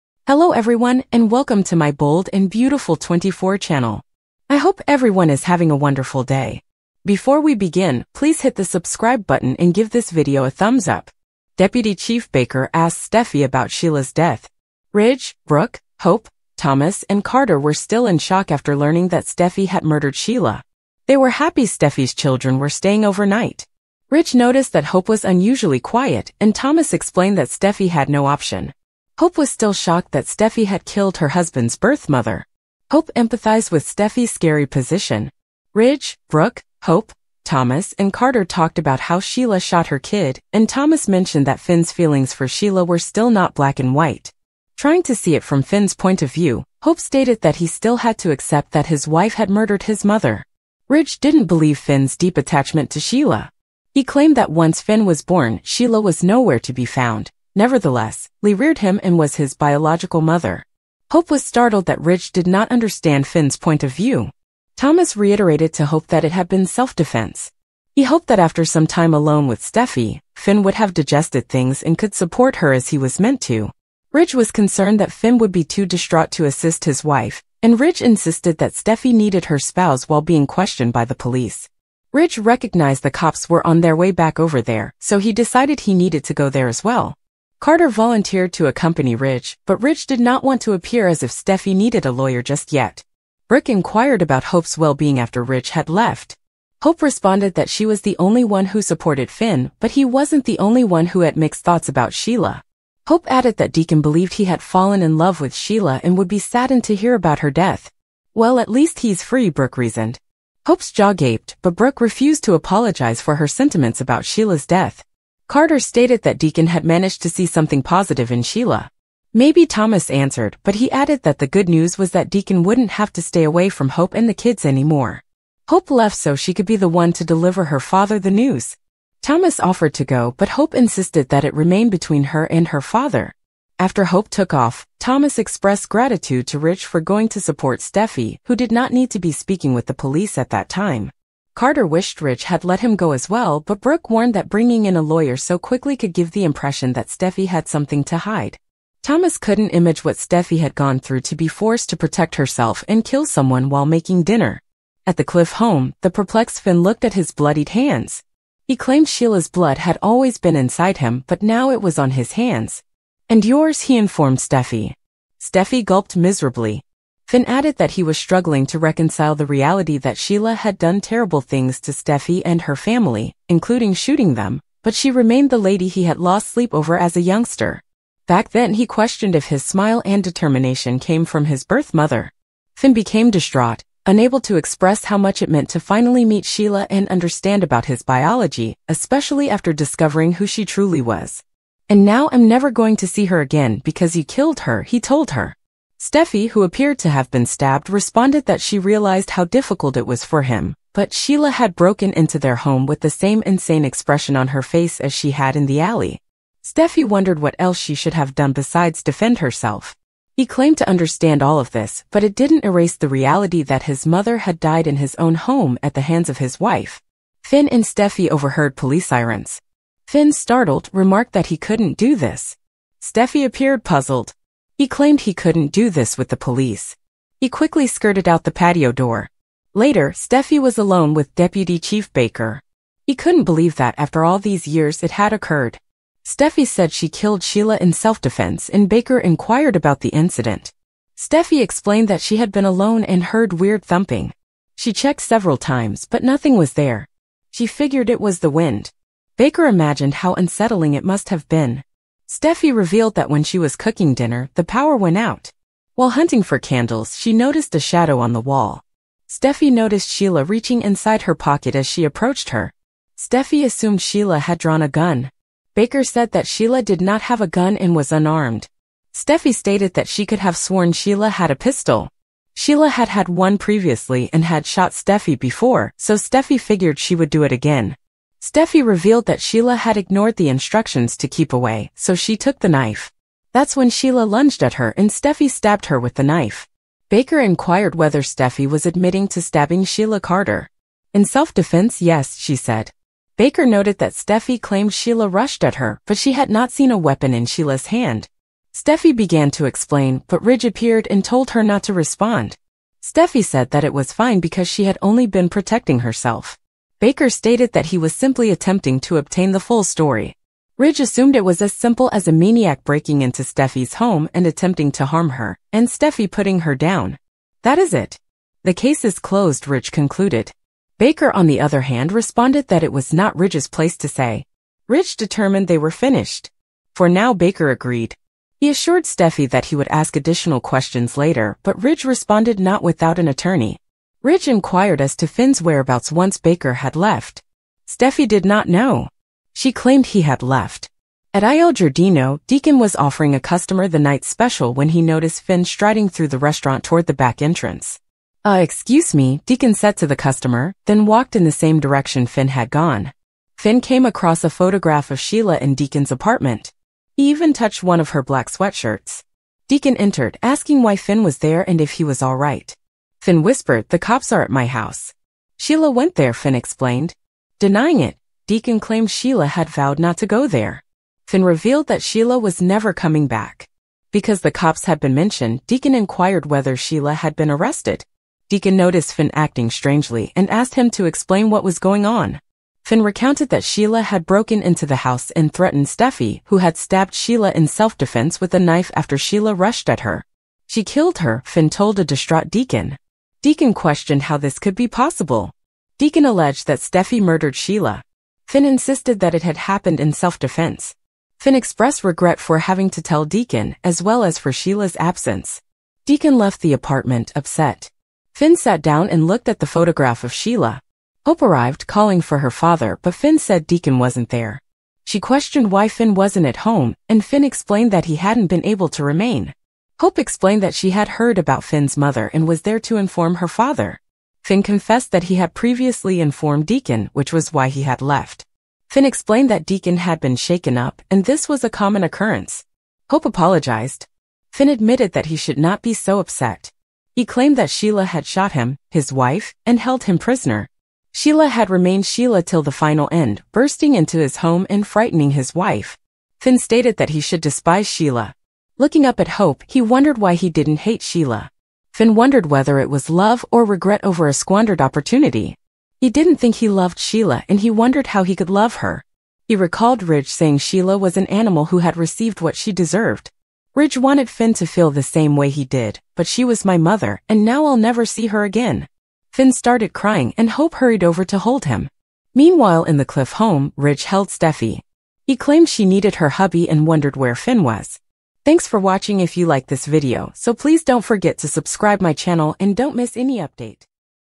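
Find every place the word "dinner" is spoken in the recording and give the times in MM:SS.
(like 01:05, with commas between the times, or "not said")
02:34, 04:14.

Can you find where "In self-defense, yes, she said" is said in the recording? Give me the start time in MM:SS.
04:51.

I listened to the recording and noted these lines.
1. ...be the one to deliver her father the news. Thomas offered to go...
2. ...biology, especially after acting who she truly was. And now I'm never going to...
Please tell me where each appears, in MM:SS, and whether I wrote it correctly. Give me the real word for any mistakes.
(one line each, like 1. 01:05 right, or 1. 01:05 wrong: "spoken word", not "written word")
1. 02:06 right
2. 03:08 wrong: "discovering", not "acting".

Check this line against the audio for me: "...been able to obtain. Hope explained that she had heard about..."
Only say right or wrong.
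wrong.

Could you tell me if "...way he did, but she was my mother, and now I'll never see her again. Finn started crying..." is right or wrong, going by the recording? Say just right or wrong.
right.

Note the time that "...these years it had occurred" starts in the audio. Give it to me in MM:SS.
03:54.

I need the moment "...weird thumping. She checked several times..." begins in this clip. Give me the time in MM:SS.
04:03.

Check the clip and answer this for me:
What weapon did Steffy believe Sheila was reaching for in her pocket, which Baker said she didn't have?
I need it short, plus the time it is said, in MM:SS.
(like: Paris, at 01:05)
pistol, at 04:31.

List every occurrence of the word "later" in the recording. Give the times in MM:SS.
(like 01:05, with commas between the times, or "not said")
03:49, 05:31.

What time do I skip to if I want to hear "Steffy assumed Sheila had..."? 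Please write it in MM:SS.
04:23.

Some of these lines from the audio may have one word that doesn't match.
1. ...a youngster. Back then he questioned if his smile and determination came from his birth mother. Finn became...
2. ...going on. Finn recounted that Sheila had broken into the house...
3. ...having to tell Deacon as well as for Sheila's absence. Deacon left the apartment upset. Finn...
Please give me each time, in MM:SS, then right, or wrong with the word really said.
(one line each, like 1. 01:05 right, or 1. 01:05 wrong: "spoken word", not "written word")
1. 02:57 right
2. 06:21 right
3. 06:42 right.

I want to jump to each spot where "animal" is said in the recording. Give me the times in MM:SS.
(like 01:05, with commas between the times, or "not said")
07:41.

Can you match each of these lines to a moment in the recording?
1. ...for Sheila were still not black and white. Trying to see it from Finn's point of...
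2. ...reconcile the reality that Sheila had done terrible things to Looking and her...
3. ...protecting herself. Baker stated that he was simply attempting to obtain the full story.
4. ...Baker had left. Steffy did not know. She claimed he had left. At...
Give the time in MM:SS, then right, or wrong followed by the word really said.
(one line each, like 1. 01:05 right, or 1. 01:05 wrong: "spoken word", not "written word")
1. 00:42 right
2. 02:48 wrong: "Steffy", not "Looking"
3. 05:05 right
4. 05:36 right.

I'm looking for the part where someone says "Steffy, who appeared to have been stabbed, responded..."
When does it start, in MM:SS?
03:16.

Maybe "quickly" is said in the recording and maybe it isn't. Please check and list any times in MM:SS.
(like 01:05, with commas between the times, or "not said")
02:25, 03:47.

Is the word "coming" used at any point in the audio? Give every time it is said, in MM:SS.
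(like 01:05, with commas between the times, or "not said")
06:12.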